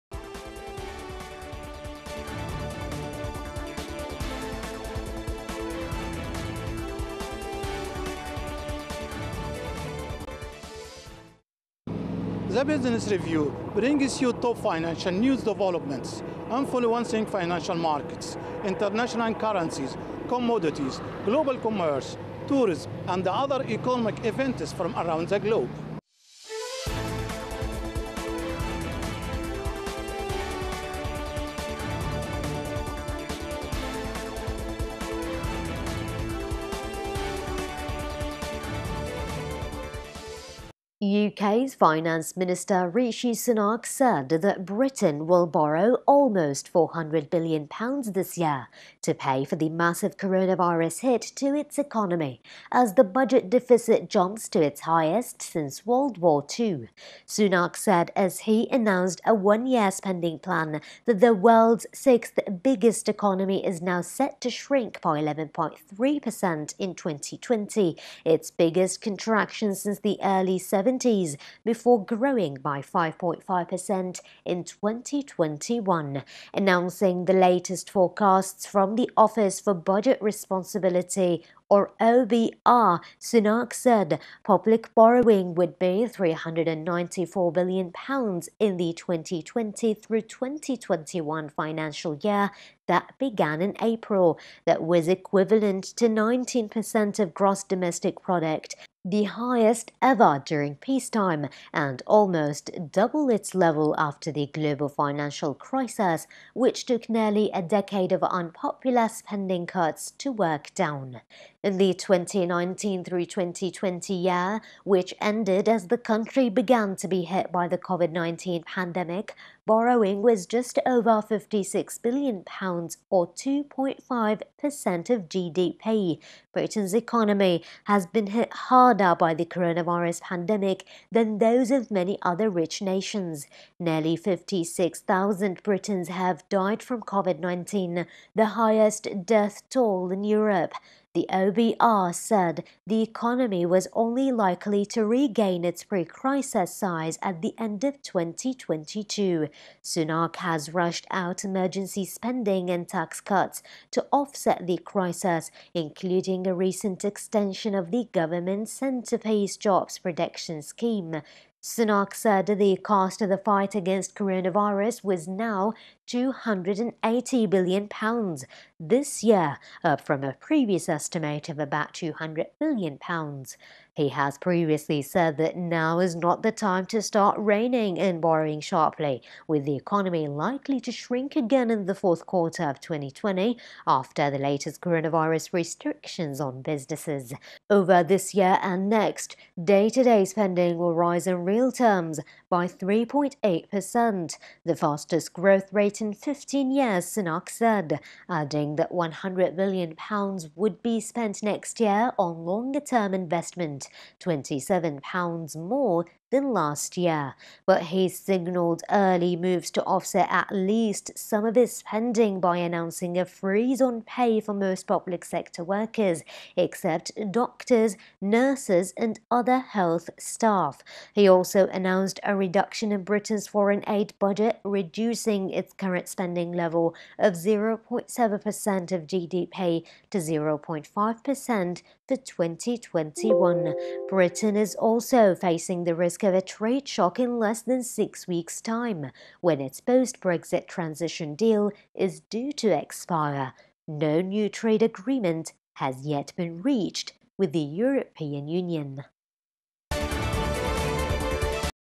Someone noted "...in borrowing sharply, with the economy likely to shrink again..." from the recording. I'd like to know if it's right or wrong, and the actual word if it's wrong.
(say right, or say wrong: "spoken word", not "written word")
right.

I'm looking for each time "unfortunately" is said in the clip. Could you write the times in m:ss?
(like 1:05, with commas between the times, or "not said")
not said.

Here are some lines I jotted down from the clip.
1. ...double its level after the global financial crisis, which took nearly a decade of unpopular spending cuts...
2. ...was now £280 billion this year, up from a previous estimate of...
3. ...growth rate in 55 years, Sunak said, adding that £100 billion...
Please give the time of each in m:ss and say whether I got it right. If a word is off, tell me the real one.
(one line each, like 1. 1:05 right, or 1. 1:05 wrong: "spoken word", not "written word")
1. 1:42 right
2. 2:45 right
3. 3:15 wrong: "15", not "55".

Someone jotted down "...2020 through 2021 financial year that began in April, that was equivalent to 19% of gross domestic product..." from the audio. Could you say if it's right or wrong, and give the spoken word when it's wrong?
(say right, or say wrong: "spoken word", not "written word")
right.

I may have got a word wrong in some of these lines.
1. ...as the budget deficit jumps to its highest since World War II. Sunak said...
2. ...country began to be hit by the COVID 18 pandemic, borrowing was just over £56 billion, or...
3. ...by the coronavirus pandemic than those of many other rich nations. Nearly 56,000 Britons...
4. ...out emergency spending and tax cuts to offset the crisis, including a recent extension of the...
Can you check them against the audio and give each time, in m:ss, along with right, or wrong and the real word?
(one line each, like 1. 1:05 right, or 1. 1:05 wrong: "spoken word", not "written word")
1. 0:52 right
2. 1:55 wrong: "19", not "18"
3. 2:09 right
4. 2:31 right.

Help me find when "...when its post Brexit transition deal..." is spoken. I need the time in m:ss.
3:59.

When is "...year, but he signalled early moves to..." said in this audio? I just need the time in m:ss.
3:26.